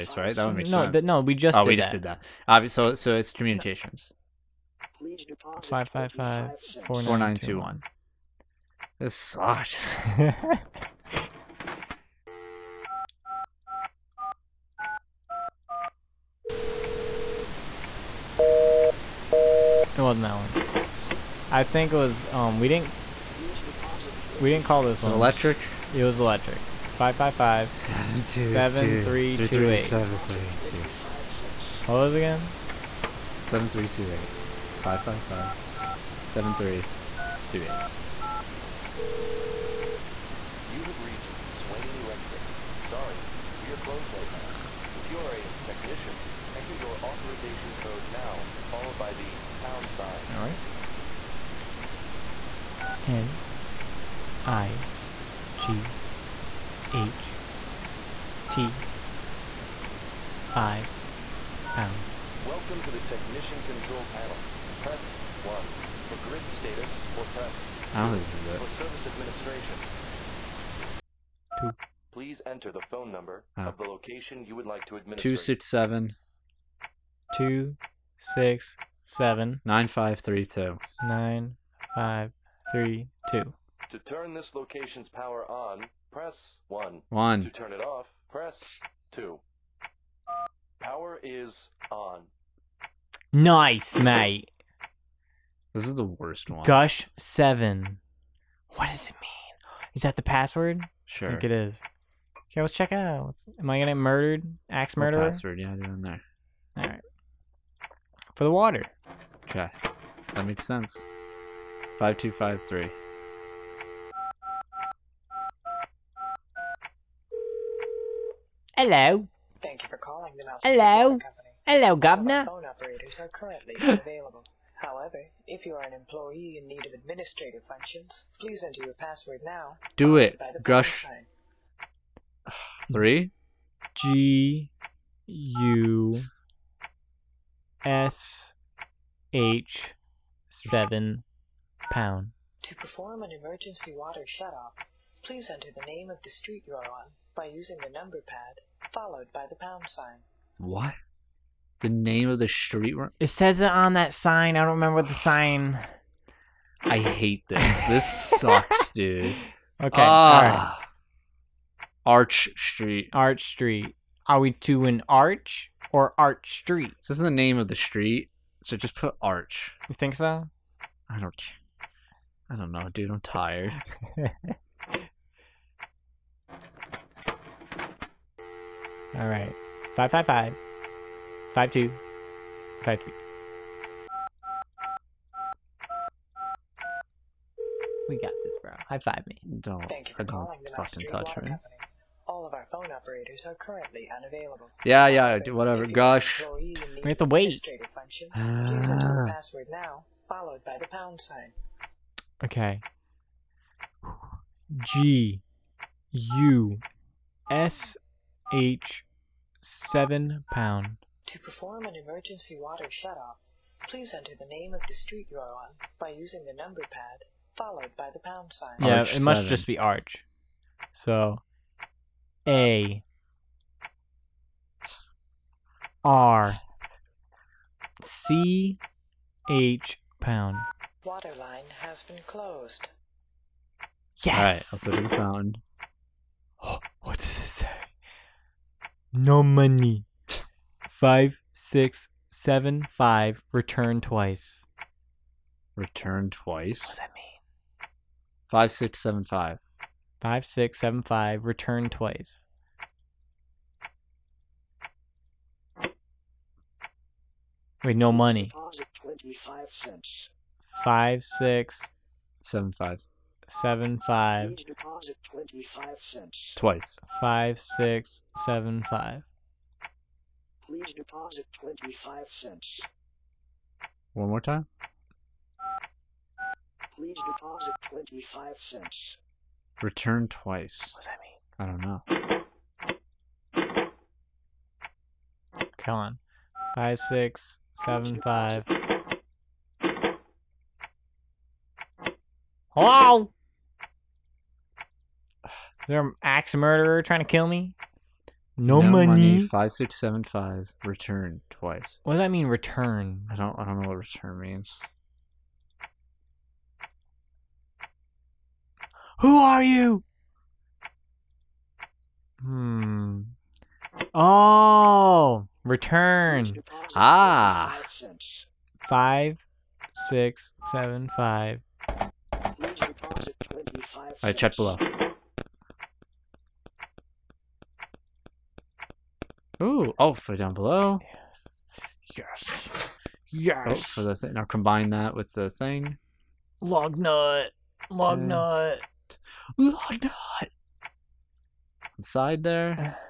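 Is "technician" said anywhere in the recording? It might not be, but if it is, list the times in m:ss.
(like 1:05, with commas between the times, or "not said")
0:45, 1:03.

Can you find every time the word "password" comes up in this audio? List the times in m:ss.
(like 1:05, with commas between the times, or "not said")
1:40, 1:45, 2:08, 3:19.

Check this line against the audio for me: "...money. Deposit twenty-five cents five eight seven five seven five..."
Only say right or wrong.
wrong.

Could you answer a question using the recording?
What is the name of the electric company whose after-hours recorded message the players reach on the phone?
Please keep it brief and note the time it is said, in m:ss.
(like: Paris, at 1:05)
Swain Electric, at 0:41.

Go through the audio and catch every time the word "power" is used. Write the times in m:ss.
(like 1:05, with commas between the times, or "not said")
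1:25, 1:30.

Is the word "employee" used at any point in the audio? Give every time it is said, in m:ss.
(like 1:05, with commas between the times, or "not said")
2:05.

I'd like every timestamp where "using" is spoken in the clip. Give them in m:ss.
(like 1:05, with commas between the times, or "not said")
2:27, 3:36.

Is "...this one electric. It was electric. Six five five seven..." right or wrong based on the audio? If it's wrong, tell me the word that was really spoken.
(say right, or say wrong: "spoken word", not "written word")
wrong: "Five", not "Six".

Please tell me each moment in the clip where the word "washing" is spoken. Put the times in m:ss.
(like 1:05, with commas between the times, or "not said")
not said.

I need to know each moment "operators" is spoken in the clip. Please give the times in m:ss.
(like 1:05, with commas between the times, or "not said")
2:02, 3:12.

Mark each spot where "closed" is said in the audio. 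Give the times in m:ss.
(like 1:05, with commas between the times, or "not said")
0:43, 3:52.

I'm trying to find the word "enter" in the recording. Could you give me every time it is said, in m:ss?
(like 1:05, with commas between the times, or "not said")
0:46, 1:12, 2:08, 2:25, 3:34.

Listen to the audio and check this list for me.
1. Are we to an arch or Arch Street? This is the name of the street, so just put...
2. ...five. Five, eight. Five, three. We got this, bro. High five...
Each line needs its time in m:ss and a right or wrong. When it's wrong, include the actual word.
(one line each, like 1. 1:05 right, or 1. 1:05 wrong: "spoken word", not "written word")
1. 2:44 right
2. 3:00 wrong: "two", not "eight".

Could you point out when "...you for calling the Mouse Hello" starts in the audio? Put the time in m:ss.
1:59.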